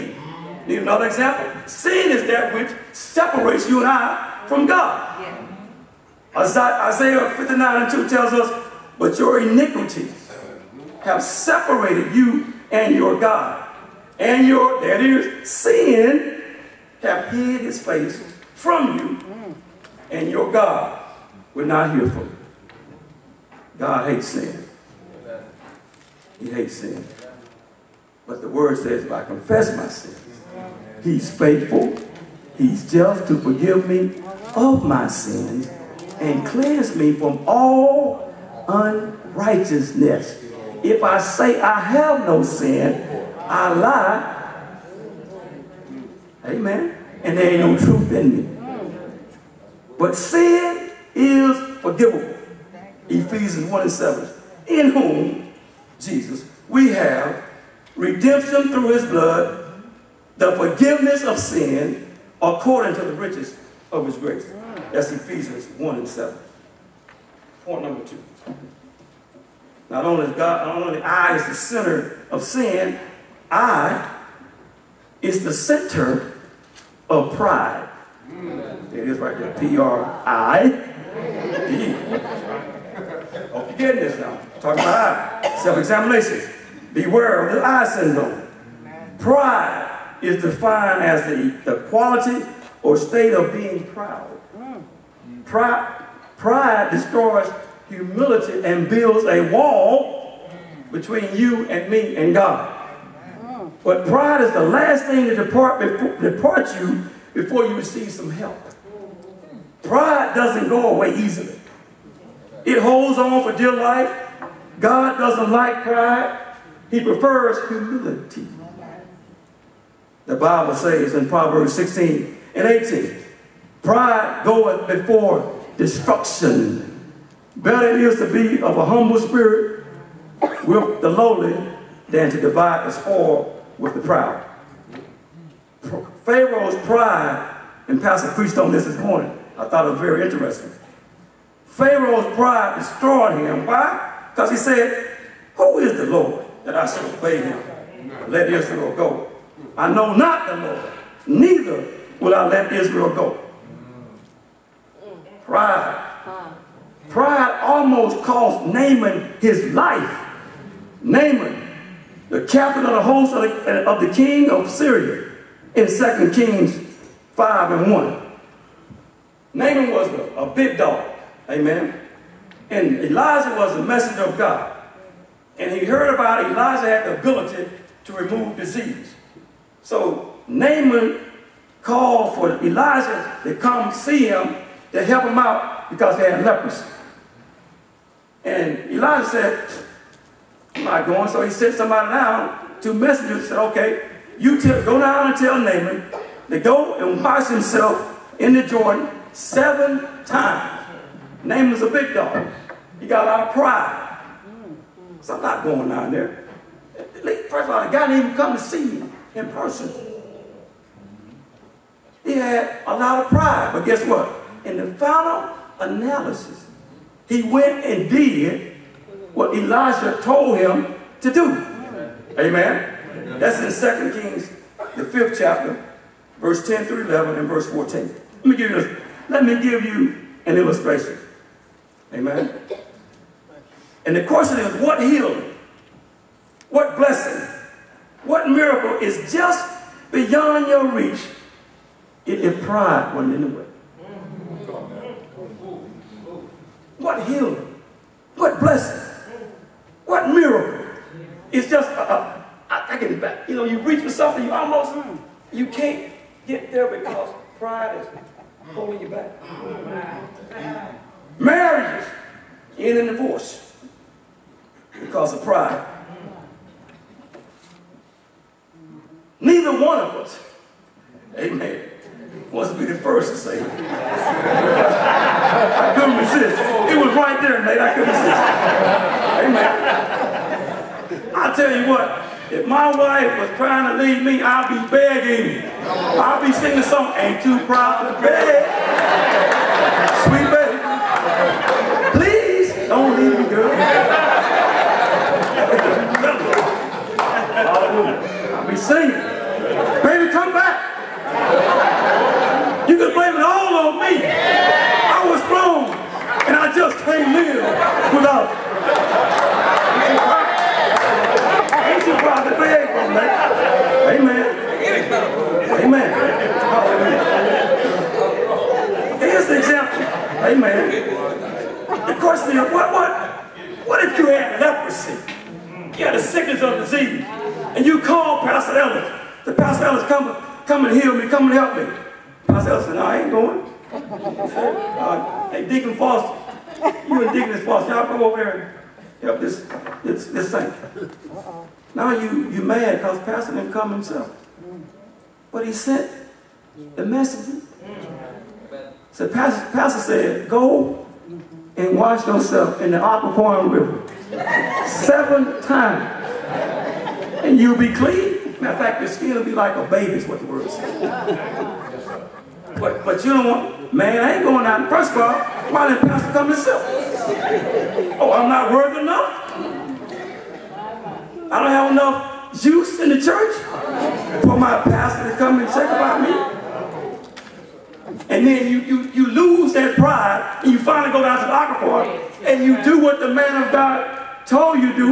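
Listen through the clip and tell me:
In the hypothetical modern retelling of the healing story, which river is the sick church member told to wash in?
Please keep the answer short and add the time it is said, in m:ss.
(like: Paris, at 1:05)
Occoquan River, at 5:53.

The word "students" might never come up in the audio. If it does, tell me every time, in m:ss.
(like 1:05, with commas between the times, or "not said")
not said.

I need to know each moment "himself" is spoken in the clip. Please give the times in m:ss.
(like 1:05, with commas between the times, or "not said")
3:17, 5:43, 6:06.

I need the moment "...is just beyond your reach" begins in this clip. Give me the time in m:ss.
3:59.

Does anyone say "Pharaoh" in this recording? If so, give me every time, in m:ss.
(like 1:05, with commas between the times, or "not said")
2:16, 2:21.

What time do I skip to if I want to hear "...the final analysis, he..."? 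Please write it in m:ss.
3:34.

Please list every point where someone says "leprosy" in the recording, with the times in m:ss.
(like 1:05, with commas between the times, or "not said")
3:06, 5:24.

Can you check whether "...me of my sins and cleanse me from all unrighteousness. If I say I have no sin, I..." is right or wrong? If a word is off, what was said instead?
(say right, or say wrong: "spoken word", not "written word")
right.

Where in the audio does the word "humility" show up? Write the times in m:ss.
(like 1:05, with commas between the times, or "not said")
1:37, 1:57.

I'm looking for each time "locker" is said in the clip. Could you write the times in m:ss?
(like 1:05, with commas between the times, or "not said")
6:21.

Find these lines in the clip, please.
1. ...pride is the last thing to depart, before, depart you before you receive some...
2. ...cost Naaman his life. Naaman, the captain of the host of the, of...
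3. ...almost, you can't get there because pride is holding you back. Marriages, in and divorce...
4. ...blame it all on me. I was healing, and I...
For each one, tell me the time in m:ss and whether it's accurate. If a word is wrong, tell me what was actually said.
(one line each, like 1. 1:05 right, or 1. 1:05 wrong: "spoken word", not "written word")
1. 1:44 right
2. 2:38 right
3. 4:14 right
4. 5:03 wrong: "wrong", not "healing".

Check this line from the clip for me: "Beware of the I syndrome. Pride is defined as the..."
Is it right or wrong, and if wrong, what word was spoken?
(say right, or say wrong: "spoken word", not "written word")
right.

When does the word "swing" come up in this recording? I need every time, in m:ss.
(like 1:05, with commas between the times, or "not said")
not said.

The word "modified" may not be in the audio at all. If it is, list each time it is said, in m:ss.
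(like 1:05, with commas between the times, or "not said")
not said.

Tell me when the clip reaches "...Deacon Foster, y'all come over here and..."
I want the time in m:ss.
5:37.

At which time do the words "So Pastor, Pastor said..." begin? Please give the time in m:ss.
5:49.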